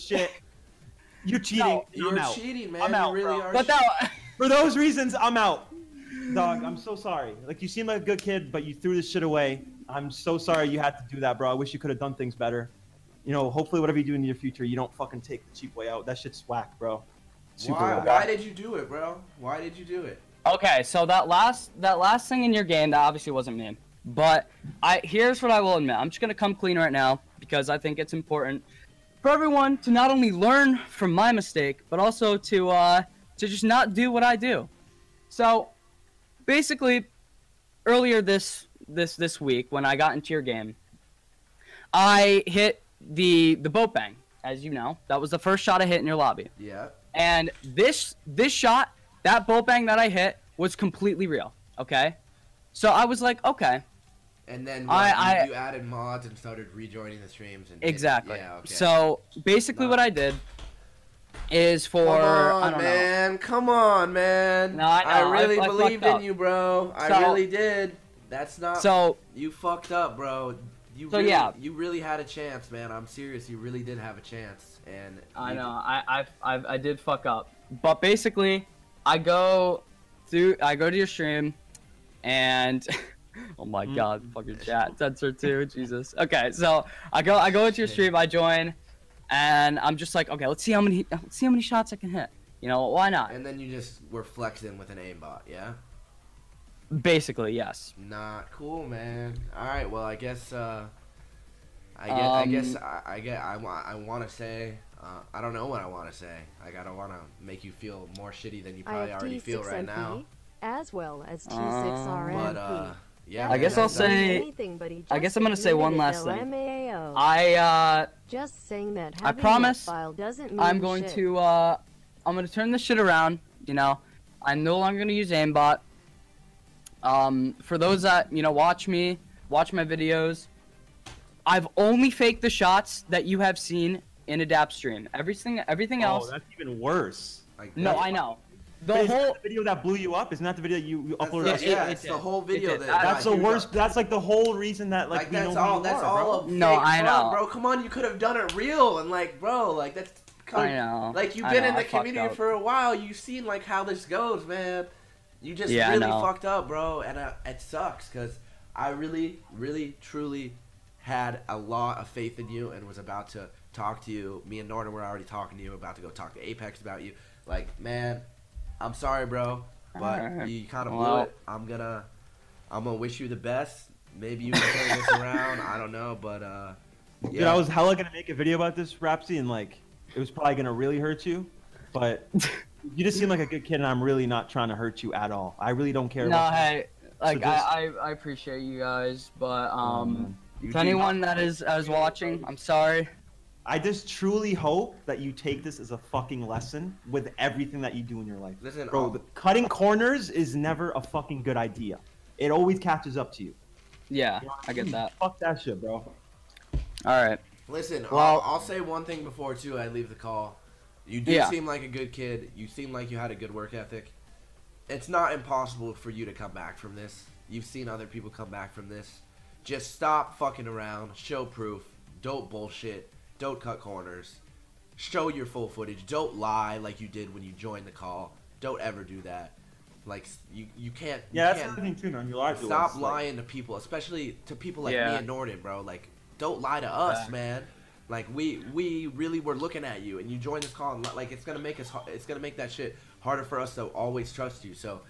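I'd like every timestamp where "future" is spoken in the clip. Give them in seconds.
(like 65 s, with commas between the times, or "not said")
14 s.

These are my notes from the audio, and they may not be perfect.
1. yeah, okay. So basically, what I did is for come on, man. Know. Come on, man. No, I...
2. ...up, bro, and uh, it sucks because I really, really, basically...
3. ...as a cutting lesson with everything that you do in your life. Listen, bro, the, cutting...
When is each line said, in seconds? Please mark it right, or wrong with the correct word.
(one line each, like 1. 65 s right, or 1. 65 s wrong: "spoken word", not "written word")
1. 58 s right
2. 156 s wrong: "truly", not "basically"
3. 195 s wrong: "fucking", not "cutting".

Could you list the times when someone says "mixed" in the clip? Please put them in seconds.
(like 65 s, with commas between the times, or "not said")
not said.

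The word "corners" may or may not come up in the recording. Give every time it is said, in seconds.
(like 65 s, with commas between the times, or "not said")
199 s, 223 s.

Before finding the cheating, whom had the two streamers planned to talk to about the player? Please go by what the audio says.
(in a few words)
Apex.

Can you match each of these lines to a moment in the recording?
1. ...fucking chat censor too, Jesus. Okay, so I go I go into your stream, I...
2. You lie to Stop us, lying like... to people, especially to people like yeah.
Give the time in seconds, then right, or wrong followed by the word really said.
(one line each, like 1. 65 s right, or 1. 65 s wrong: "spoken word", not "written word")
1. 84 s right
2. 232 s right.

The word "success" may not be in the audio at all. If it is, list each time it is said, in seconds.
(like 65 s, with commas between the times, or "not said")
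not said.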